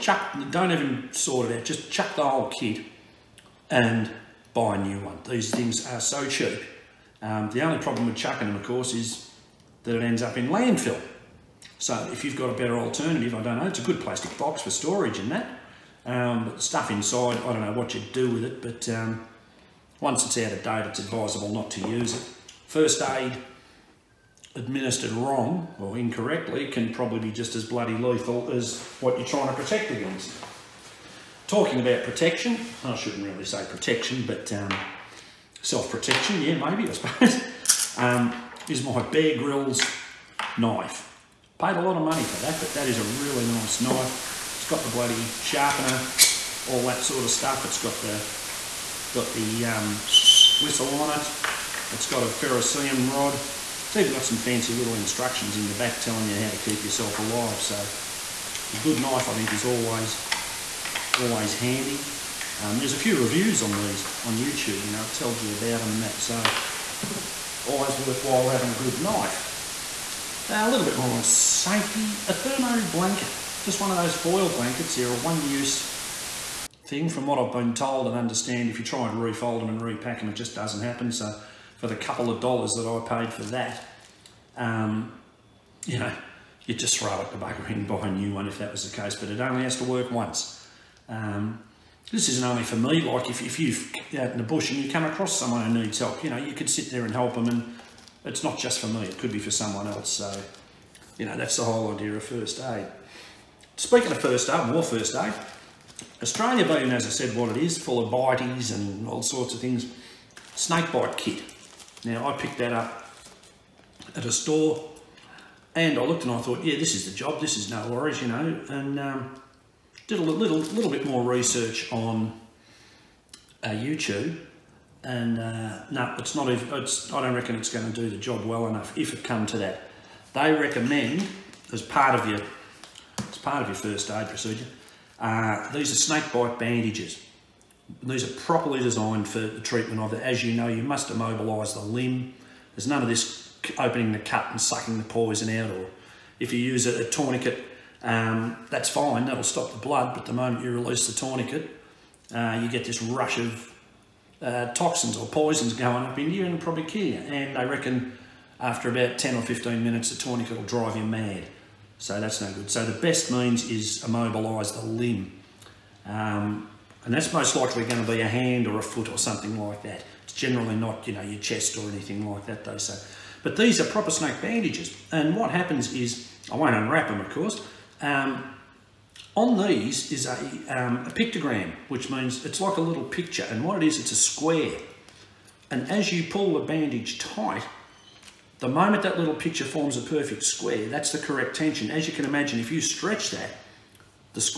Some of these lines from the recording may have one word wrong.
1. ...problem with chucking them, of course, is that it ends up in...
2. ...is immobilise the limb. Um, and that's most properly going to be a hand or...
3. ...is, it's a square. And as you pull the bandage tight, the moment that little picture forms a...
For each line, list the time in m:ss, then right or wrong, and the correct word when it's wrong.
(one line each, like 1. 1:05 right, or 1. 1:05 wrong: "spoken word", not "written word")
1. 0:07 right
2. 2:43 wrong: "likely", not "properly"
3. 3:03 right.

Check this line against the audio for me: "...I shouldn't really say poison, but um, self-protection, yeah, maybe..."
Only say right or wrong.
wrong.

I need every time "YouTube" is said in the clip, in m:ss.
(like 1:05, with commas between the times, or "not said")
1:04, 2:03.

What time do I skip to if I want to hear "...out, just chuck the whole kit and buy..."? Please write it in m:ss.
0:01.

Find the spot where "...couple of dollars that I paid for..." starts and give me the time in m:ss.
1:21.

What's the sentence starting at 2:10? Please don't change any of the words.
They recommend, as part of your, as part of your first aid procedure, uh, these are snake bite bandages.